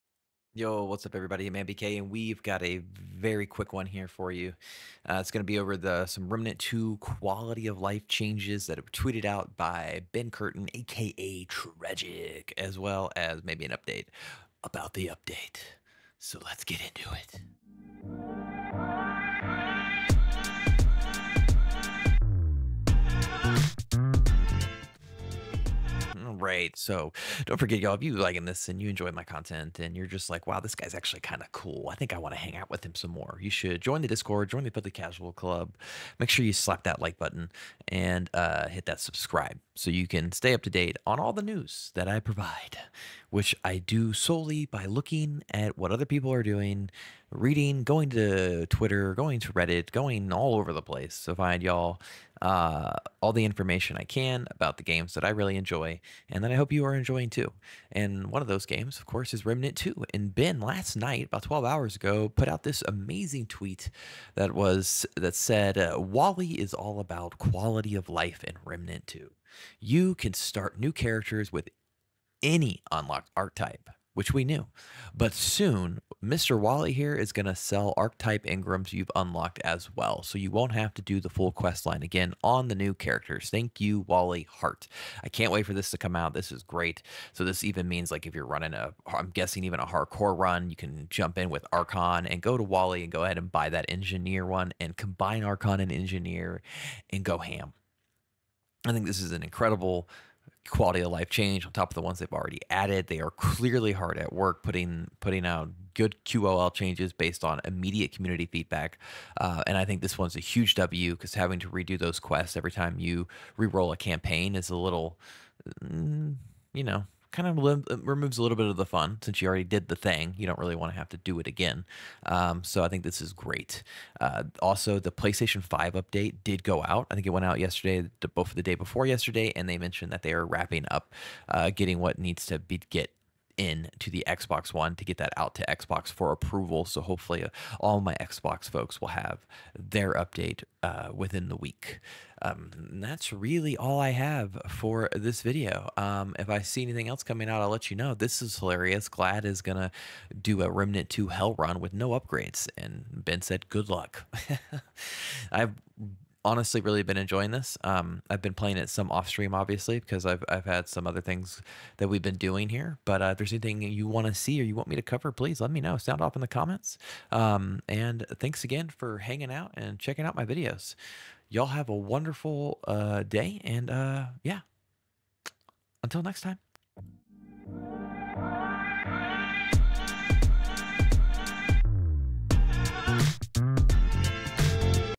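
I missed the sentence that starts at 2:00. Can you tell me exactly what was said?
You don't really want to have to do it again.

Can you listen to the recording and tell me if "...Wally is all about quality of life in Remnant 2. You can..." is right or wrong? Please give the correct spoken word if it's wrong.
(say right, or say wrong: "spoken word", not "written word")
right.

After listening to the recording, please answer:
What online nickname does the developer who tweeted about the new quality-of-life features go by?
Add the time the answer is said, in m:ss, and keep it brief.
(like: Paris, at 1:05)
Tragic, at 0:11.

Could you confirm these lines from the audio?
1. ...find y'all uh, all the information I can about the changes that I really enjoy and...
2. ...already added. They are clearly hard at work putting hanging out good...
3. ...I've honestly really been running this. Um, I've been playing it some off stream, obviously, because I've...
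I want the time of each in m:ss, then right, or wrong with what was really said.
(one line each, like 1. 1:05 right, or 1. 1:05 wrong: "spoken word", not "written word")
1. 0:51 wrong: "games", not "changes"
2. 1:42 wrong: "putting", not "hanging"
3. 2:35 wrong: "enjoying", not "running".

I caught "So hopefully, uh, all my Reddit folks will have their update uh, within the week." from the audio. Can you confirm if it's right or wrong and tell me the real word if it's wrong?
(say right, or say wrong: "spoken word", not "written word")
wrong: "Xbox", not "Reddit".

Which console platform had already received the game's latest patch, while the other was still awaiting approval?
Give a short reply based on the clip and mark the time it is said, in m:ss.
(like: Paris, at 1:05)
PlayStation 5, at 2:05.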